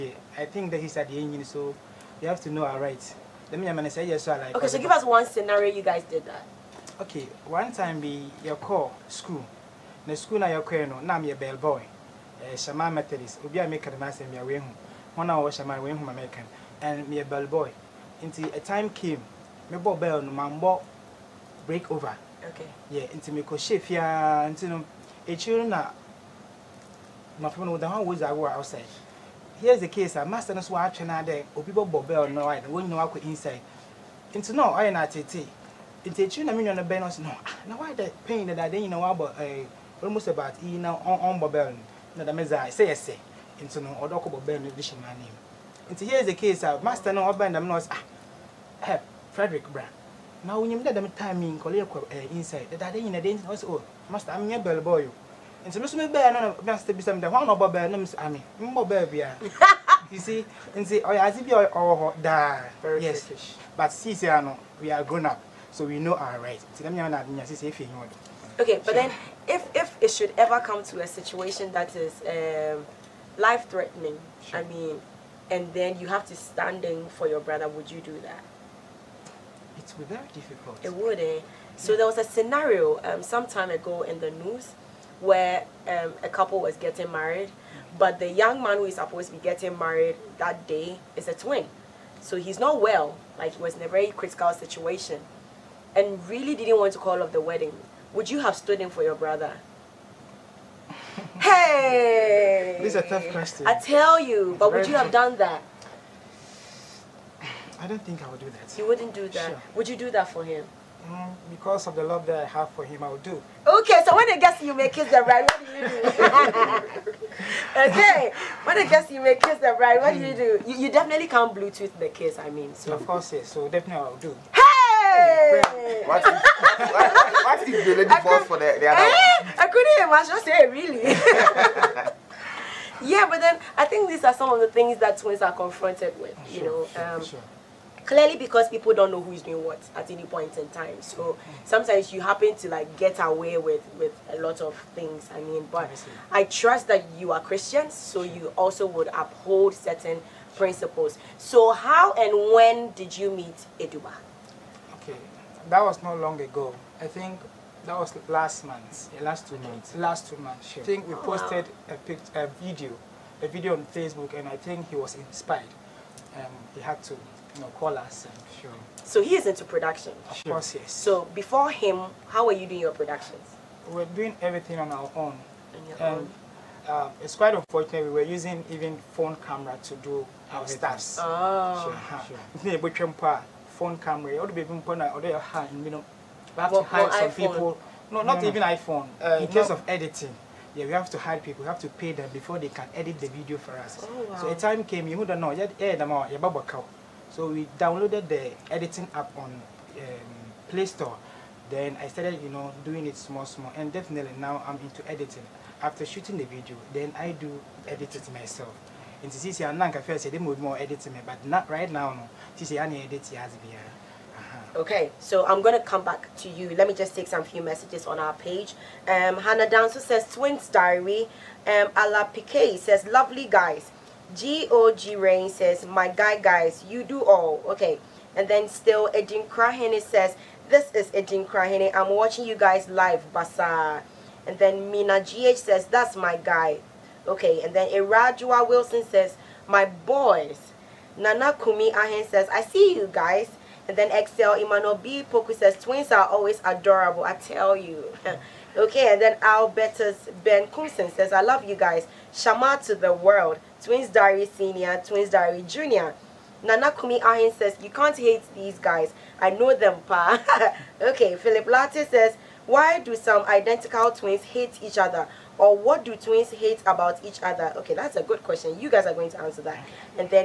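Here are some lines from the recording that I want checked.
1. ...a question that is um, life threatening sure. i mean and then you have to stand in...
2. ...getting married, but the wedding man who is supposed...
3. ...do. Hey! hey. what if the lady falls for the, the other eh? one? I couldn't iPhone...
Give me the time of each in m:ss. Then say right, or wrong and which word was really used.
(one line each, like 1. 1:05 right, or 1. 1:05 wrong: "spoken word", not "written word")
1. 1:10 wrong: "situation", not "question"
2. 1:26 wrong: "young", not "wedding"
3. 2:04 wrong: "imagine", not "iPhone".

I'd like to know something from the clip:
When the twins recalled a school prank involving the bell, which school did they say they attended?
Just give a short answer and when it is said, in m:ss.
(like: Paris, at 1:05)
Shama Methodist, at 0:12.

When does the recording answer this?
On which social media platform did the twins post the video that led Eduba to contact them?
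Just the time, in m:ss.
2:43.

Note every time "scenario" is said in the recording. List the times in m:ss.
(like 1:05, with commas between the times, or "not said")
0:05, 1:22.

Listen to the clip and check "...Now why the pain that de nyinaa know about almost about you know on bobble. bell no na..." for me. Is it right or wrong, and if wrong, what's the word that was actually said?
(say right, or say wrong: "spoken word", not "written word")
right.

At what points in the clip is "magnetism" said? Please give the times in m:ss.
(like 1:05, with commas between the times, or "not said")
not said.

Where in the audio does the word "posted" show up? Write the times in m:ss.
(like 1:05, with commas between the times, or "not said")
2:41.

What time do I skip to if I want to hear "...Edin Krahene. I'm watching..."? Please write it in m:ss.
3:51.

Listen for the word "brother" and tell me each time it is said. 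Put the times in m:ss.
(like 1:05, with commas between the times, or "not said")
1:17, 1:39.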